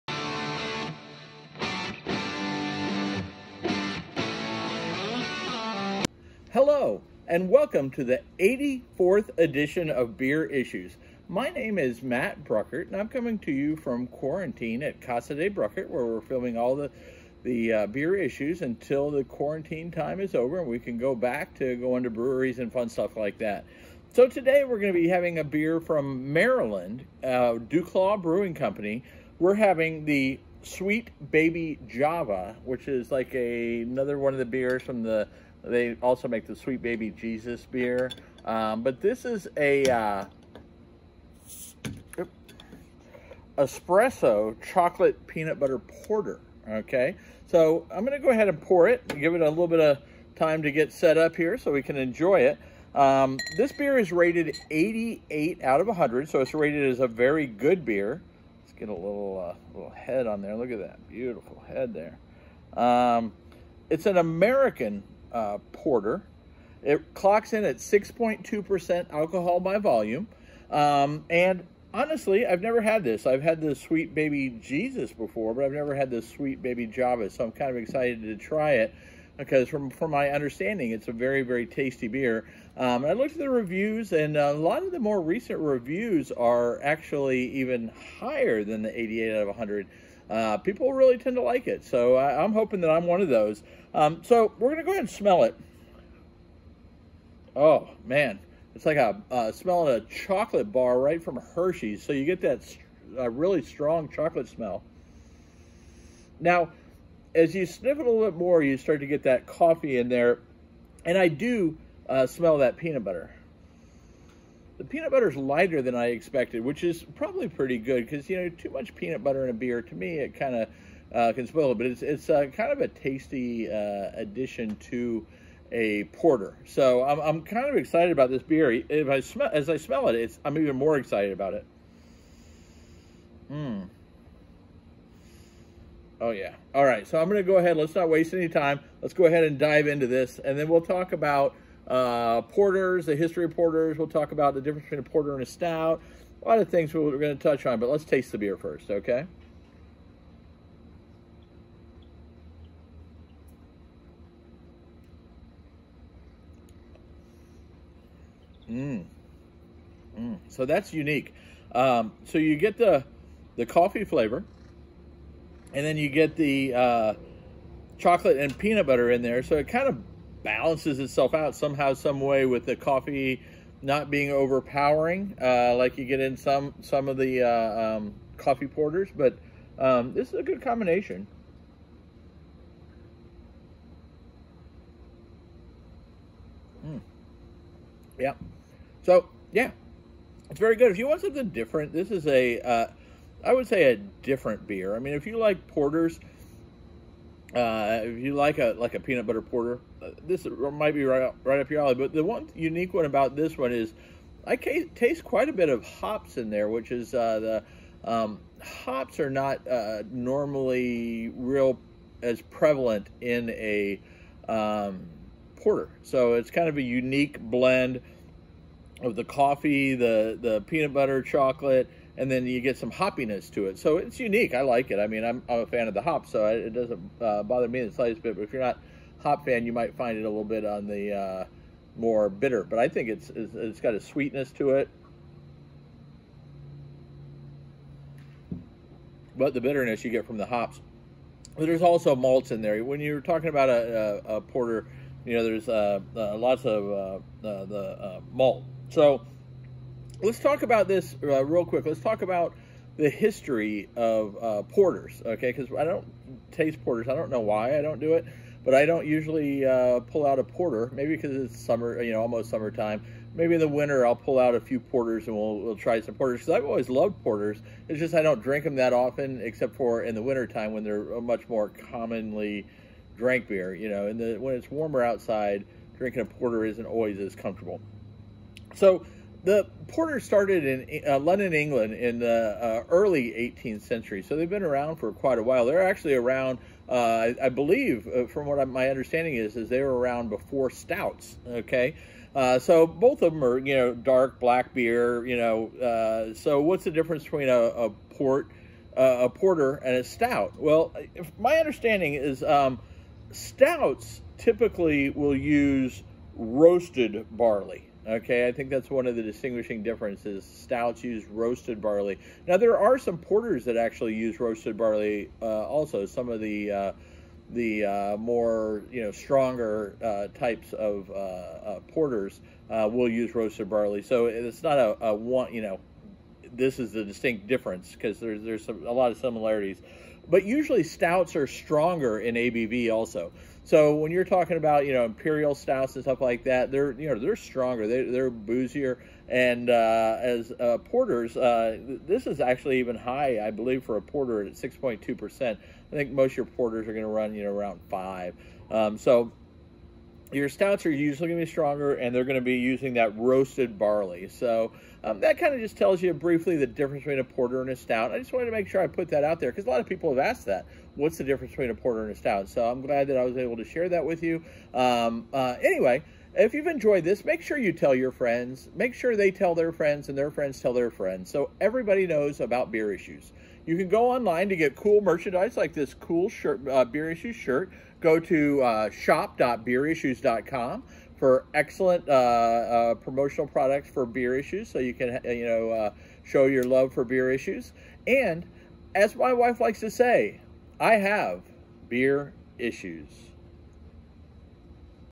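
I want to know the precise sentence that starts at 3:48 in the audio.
But if you're not hop fan, you might find it a little bit on the uh, more bitter.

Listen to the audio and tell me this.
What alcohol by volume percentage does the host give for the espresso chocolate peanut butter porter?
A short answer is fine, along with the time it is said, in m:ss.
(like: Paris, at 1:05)
6.2%, at 1:07.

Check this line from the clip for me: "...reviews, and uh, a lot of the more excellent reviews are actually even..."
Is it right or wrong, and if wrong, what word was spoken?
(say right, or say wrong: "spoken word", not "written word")
wrong: "recent", not "excellent".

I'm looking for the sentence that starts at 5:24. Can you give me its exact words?
So it's not a, a one, you know, this is the distinct difference because there's, there's some, a lot of similarities.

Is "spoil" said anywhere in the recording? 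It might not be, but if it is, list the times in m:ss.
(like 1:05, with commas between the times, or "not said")
2:01.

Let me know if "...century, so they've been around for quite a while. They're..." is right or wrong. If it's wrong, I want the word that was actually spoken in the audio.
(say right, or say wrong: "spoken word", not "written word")
right.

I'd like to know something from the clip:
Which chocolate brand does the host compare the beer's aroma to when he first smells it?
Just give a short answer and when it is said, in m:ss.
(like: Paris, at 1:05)
Hershey's, at 1:41.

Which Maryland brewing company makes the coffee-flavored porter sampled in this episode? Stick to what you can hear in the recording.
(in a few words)
Duclaw Brewing Company.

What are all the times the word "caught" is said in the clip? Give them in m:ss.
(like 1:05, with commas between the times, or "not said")
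not said.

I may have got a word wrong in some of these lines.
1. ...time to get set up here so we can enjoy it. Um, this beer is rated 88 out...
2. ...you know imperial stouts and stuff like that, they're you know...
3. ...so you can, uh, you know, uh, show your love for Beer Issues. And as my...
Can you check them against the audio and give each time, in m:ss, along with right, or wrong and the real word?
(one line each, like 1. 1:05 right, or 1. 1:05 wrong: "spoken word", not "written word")
1. 0:50 right
2. 5:34 right
3. 6:24 right.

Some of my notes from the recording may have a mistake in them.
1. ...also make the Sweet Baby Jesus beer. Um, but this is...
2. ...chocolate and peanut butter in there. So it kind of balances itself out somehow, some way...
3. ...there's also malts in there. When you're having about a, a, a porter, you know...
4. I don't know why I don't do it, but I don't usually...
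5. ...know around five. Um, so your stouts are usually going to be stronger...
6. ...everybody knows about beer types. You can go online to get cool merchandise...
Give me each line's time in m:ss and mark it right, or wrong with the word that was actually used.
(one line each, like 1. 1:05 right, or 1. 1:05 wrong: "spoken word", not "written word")
1. 0:36 right
2. 2:47 right
3. 4:01 wrong: "talking", not "having"
4. 4:17 right
5. 5:47 right
6. 6:11 wrong: "issues", not "types".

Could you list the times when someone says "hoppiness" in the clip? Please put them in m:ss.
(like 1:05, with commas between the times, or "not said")
3:42.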